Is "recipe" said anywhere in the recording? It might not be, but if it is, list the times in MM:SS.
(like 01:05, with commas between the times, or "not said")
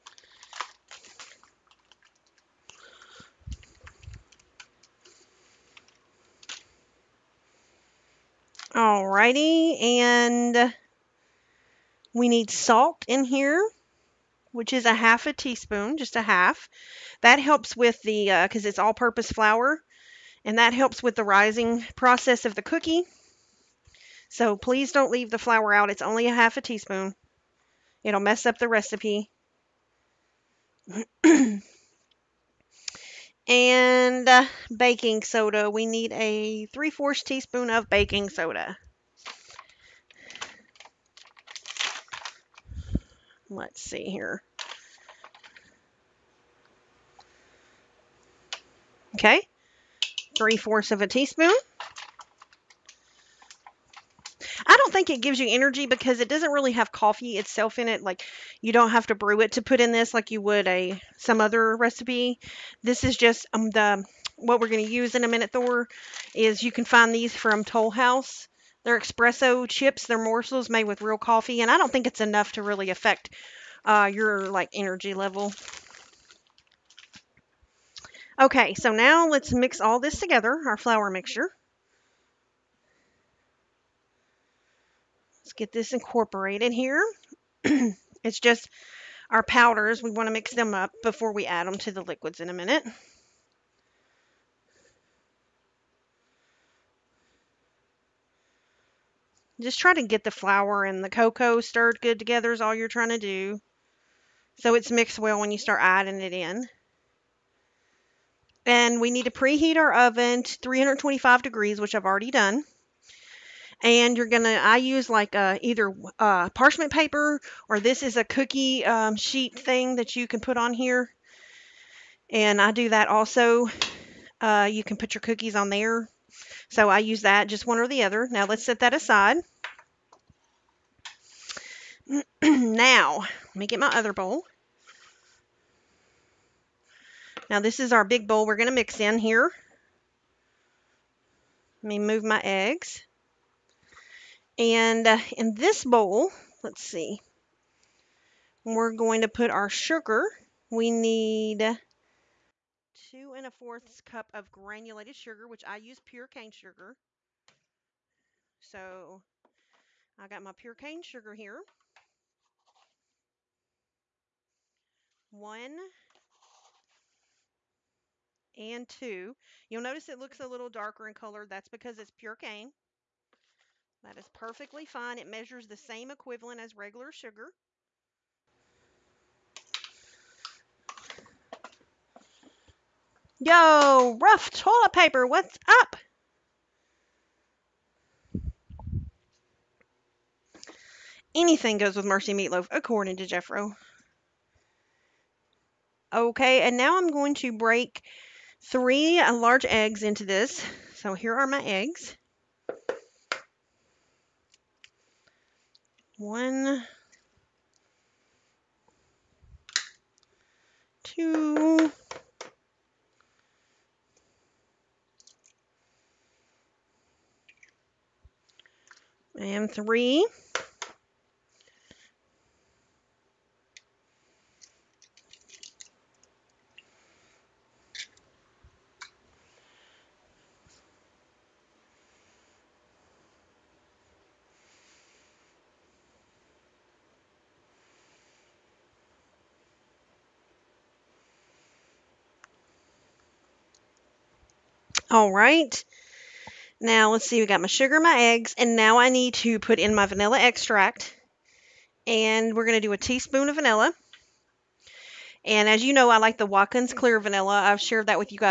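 00:28, 01:01.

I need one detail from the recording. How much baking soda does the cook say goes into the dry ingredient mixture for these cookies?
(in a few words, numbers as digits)
3/4 teaspoon.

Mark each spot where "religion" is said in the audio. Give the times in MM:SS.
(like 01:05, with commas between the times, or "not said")
not said.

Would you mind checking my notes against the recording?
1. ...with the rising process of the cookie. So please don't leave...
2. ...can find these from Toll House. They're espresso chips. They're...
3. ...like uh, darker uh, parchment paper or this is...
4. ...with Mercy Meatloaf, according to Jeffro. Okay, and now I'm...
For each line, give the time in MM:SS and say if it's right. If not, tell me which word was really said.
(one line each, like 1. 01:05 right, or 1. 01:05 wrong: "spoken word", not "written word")
1. 00:21 right
2. 01:06 right
3. 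01:55 wrong: "either", not "darker"
4. 03:11 right.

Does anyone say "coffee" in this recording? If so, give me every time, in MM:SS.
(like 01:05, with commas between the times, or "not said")
00:56, 01:11.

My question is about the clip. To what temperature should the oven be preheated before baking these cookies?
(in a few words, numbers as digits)
325 degrees.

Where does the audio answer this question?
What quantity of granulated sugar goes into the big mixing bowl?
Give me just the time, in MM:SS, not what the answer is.
02:32.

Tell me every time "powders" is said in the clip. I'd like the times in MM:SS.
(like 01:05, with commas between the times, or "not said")
01:29.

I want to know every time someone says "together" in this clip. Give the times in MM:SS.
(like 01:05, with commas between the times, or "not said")
01:20, 01:42.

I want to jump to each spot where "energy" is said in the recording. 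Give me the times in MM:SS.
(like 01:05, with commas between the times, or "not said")
00:55, 01:14.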